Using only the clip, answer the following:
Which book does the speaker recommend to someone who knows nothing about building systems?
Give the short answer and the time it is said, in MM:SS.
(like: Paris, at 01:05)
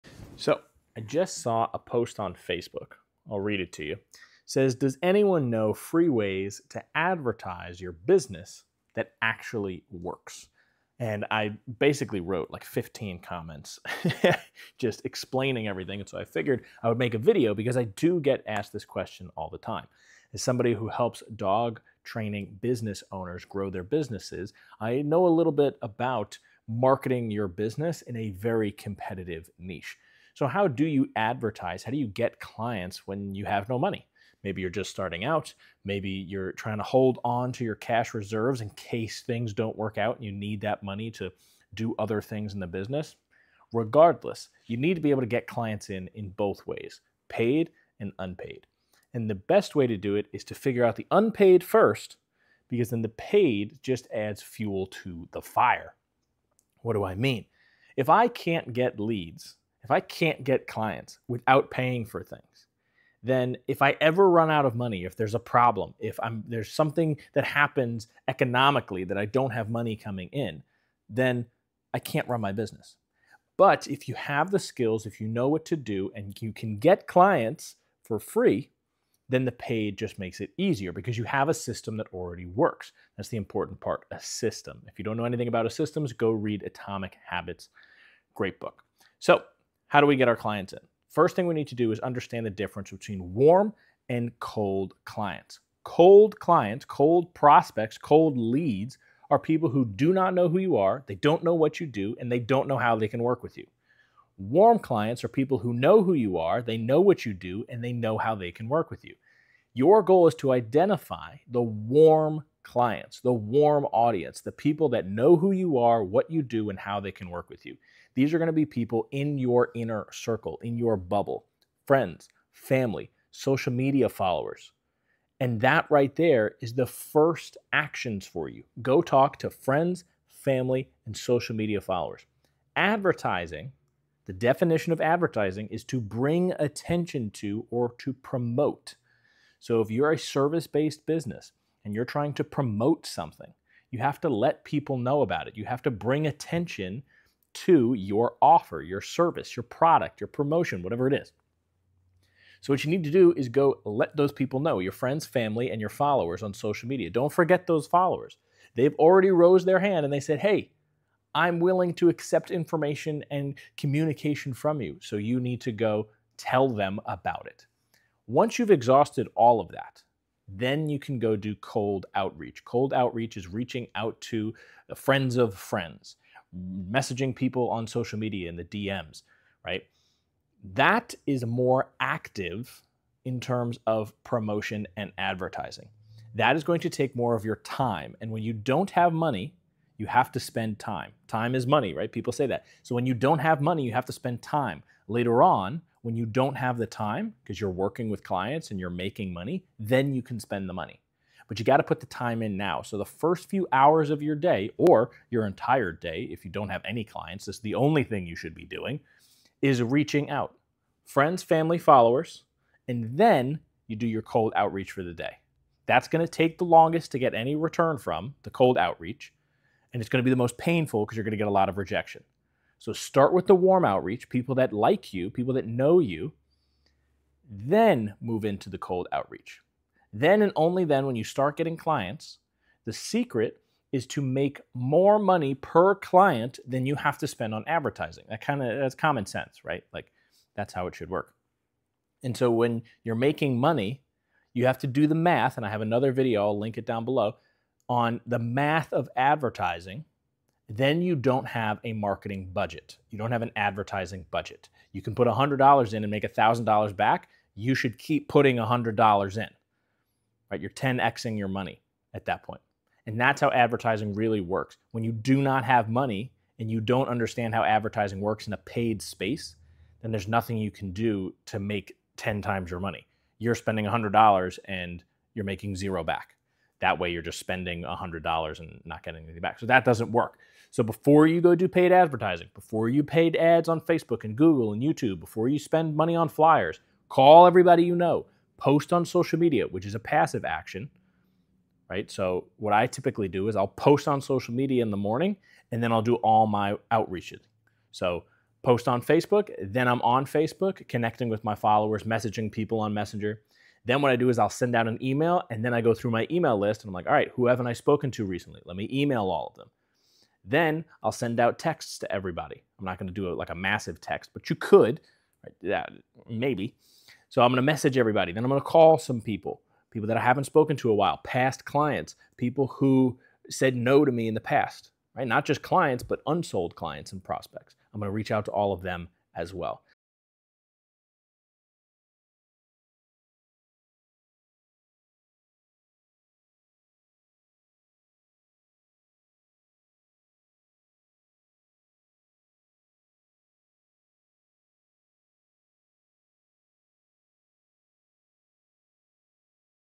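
Atomic Habits, at 01:26.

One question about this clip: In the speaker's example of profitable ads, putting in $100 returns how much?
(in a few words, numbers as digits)
$1,000.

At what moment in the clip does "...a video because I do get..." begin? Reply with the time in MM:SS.
00:17.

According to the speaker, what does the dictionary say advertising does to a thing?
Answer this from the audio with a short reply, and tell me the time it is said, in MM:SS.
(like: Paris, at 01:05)
bring attention to or to promote, at 02:15.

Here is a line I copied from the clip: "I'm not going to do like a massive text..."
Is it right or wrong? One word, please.
right.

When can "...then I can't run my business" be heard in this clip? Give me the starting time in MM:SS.
01:11.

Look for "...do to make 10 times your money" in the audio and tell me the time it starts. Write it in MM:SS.
04:30.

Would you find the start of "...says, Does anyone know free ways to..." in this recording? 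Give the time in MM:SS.
00:04.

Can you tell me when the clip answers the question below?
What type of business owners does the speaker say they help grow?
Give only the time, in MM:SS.
00:21.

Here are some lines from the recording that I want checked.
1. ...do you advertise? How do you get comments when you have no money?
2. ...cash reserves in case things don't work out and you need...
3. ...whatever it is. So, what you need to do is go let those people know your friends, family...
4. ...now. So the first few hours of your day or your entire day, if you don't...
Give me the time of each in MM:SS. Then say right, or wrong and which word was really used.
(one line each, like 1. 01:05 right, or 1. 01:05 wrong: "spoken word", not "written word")
1. 00:30 wrong: "clients", not "comments"
2. 00:37 right
3. 02:30 right
4. 03:22 right.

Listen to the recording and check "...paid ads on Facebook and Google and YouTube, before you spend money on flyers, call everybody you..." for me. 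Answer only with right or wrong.
right.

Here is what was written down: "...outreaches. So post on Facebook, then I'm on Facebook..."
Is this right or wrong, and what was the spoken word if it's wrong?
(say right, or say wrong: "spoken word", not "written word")
right.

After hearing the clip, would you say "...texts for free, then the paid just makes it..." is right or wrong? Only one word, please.
wrong.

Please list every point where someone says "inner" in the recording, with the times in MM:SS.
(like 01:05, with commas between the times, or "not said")
01:59.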